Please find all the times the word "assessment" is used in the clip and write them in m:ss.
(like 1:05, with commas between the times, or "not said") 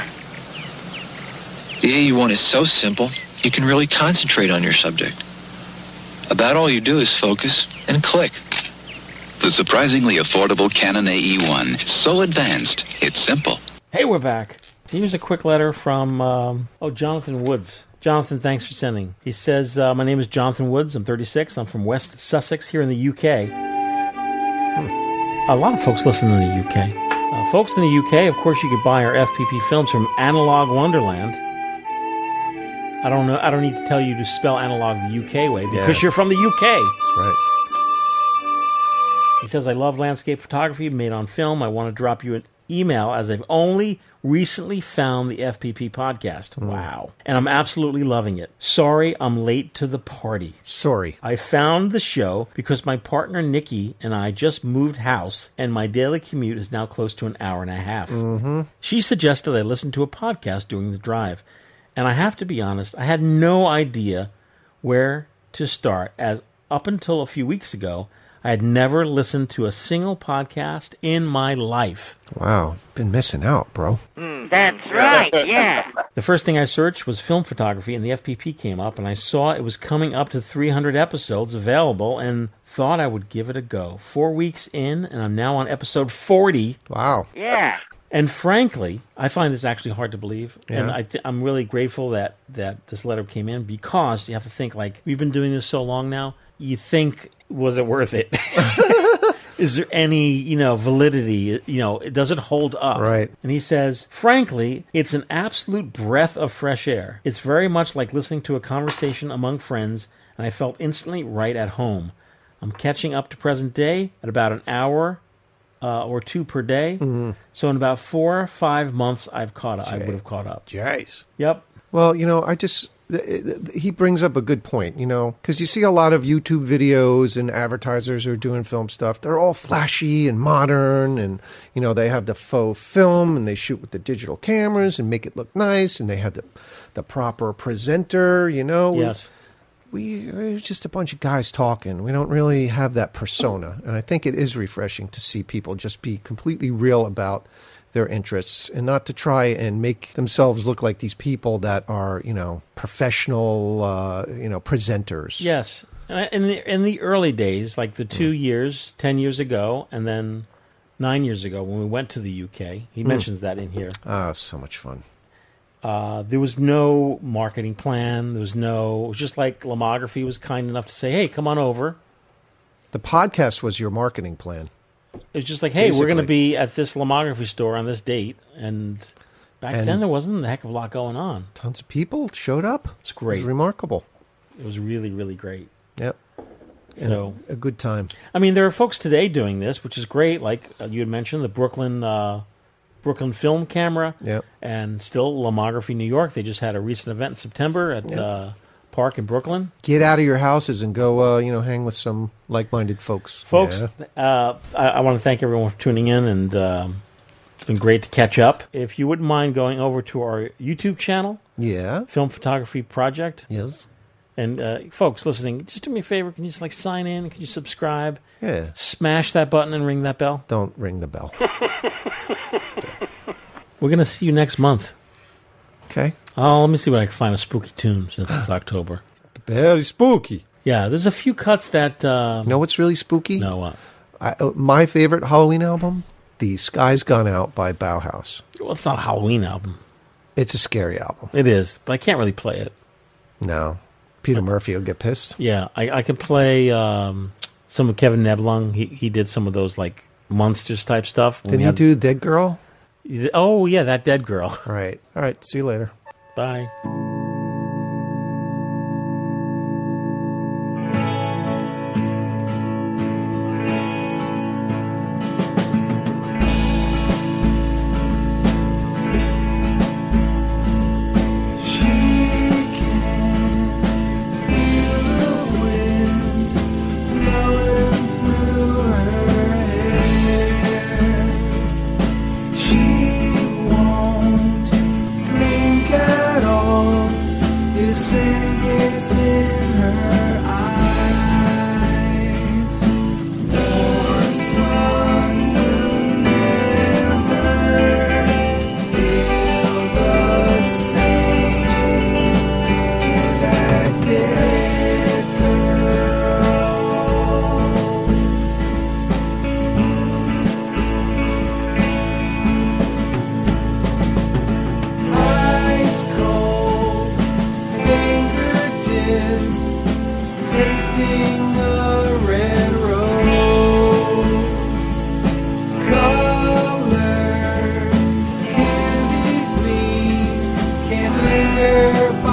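not said.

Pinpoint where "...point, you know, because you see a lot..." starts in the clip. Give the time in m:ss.
2:04.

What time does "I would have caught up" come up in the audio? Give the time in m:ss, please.
1:59.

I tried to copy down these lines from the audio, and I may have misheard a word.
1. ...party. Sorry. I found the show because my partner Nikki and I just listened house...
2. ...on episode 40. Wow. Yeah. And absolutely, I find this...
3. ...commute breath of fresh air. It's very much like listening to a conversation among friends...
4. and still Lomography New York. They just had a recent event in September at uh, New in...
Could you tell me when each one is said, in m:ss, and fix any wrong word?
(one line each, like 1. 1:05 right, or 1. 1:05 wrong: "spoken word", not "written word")
1. 0:49 wrong: "moved", not "listened"
2. 1:25 wrong: "frankly", not "absolutely"
3. 1:45 wrong: "absolute", not "commute"
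4. 3:14 wrong: "Park", not "New".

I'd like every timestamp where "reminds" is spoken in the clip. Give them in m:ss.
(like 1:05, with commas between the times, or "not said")
not said.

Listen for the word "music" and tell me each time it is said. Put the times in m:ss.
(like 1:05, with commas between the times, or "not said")
not said.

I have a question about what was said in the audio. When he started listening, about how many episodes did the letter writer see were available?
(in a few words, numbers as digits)
300.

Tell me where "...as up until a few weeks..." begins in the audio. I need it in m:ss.
1:06.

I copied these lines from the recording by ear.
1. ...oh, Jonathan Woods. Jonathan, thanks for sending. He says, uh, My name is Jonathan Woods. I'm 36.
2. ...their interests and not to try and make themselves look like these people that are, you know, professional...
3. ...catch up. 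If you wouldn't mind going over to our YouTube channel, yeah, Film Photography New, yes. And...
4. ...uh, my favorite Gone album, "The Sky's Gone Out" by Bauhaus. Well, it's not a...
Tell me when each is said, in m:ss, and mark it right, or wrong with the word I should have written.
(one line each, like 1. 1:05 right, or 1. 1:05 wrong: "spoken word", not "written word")
1. 0:16 right
2. 2:27 right
3. 3:28 wrong: "Project", not "New"
4. 3:54 wrong: "Halloween", not "Gone".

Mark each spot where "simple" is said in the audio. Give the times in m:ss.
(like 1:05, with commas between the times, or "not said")
0:02, 0:13.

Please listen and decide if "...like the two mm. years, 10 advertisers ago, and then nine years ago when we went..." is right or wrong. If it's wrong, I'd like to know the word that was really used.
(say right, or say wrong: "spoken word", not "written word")
wrong: "years", not "advertisers".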